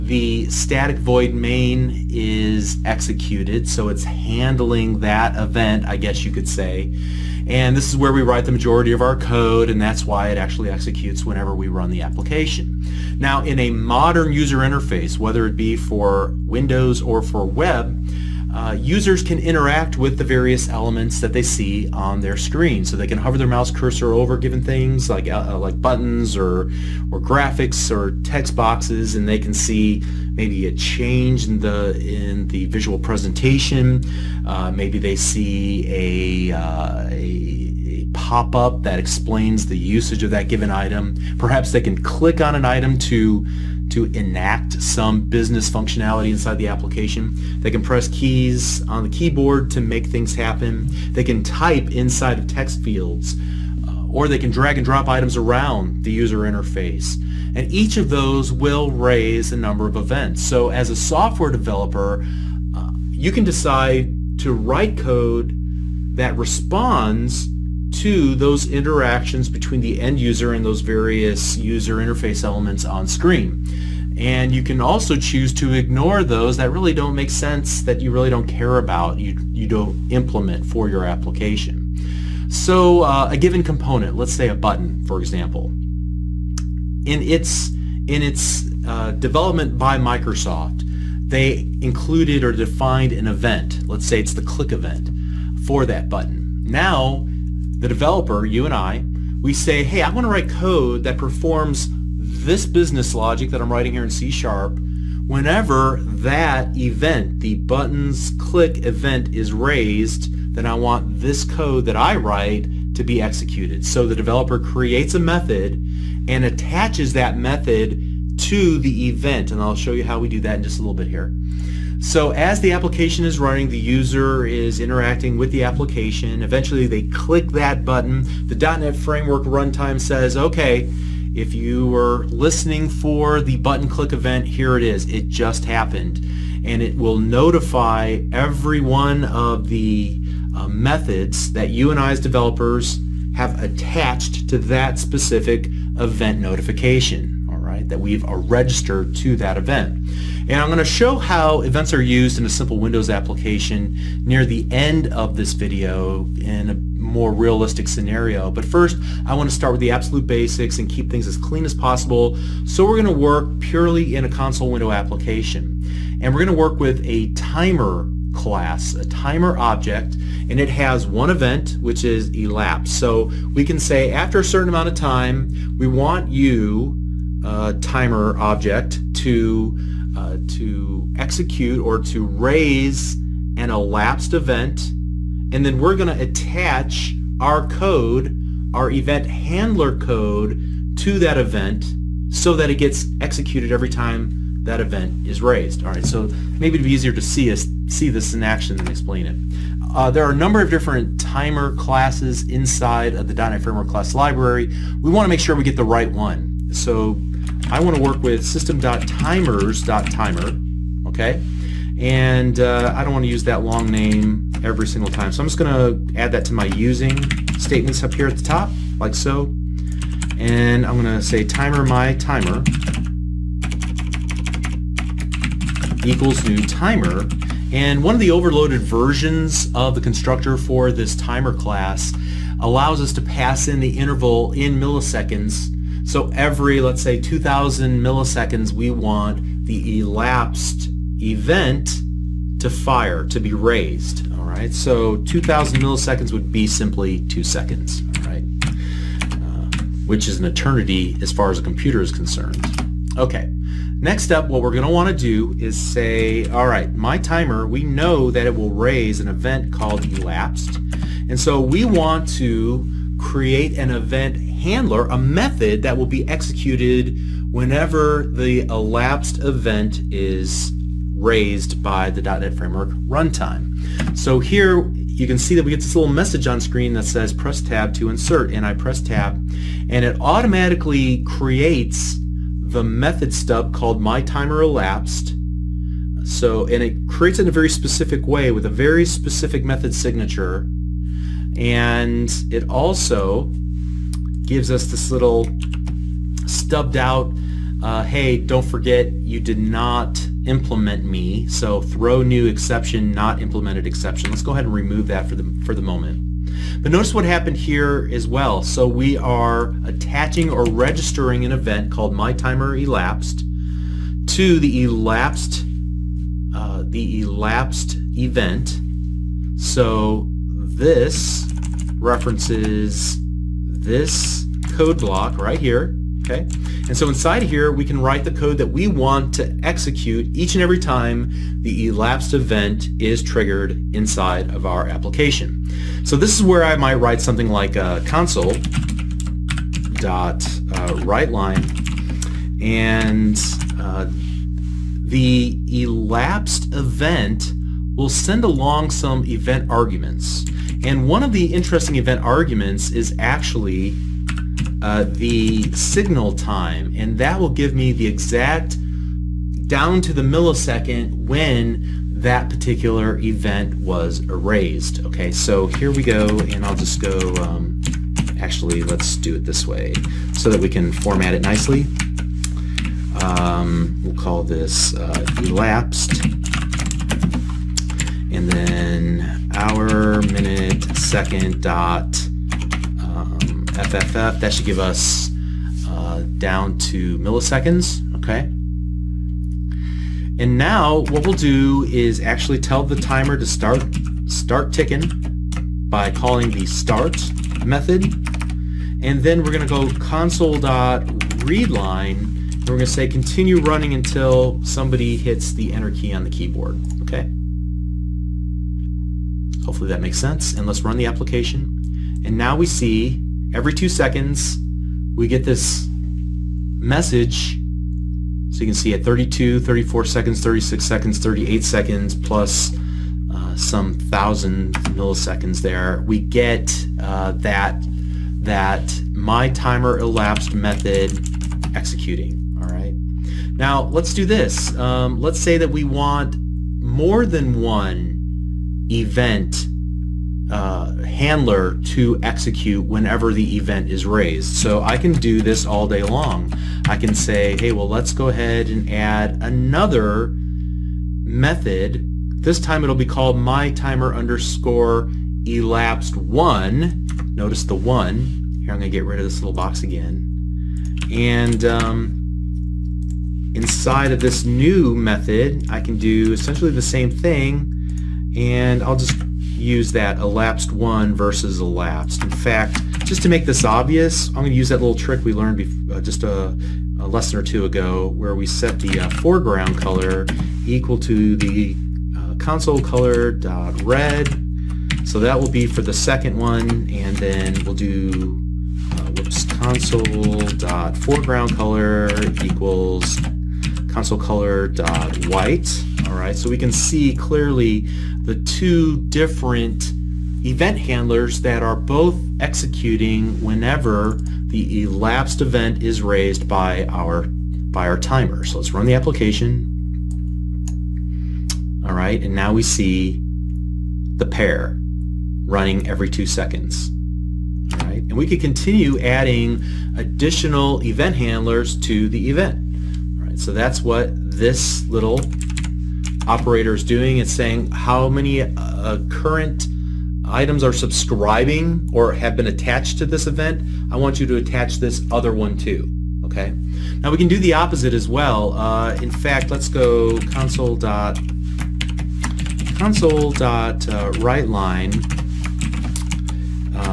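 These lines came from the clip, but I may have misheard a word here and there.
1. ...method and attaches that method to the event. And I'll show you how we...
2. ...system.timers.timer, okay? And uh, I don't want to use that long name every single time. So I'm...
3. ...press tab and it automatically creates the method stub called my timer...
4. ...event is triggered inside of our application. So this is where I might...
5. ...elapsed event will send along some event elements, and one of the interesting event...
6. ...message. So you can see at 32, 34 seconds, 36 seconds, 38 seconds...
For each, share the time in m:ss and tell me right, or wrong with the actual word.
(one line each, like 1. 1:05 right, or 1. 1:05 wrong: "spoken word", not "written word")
1. 1:55 right
2. 3:28 right
3. 4:38 right
4. 5:32 right
5. 5:45 wrong: "arguments", not "elements"
6. 6:56 right.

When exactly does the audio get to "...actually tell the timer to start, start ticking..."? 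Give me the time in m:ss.
6:32.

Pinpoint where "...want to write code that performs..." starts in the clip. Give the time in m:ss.
1:40.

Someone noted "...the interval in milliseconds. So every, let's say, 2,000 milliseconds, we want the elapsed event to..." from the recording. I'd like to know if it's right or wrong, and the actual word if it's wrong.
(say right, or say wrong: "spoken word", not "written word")
right.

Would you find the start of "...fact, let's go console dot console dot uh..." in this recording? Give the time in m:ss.
8:59.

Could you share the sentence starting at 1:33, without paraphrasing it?
Let's say it's the click event for that button.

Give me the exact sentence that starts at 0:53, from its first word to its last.
Uh, or they can drag and drop items around the user interface.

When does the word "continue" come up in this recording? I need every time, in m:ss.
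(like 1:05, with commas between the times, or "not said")
6:43, 8:38.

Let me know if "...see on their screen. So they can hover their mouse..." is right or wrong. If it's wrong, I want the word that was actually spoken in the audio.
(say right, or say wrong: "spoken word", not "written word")
right.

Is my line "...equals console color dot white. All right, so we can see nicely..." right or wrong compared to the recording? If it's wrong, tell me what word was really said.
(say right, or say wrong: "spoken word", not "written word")
wrong: "clearly", not "nicely".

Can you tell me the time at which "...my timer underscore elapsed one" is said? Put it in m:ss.
7:33.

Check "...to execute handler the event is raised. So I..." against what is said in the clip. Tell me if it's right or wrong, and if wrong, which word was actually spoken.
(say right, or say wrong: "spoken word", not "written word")
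wrong: "whenever", not "handler".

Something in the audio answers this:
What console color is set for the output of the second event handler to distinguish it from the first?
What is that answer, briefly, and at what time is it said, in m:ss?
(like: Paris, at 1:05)
Red, at 8:03.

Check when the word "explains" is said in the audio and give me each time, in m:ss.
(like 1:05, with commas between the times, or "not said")
0:38, 3:18.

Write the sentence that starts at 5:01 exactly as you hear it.
So throw new exception, not implemented exception.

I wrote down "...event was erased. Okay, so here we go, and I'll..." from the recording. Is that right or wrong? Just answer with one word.
right.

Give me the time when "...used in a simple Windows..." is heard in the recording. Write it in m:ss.
2:32.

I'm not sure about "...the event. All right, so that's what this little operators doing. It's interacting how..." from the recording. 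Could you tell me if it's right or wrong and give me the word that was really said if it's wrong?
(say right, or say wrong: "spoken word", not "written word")
wrong: "saying", not "interacting".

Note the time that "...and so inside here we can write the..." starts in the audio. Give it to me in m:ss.
5:26.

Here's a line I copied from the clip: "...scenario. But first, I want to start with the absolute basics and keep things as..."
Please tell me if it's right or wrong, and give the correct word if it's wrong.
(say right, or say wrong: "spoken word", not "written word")
right.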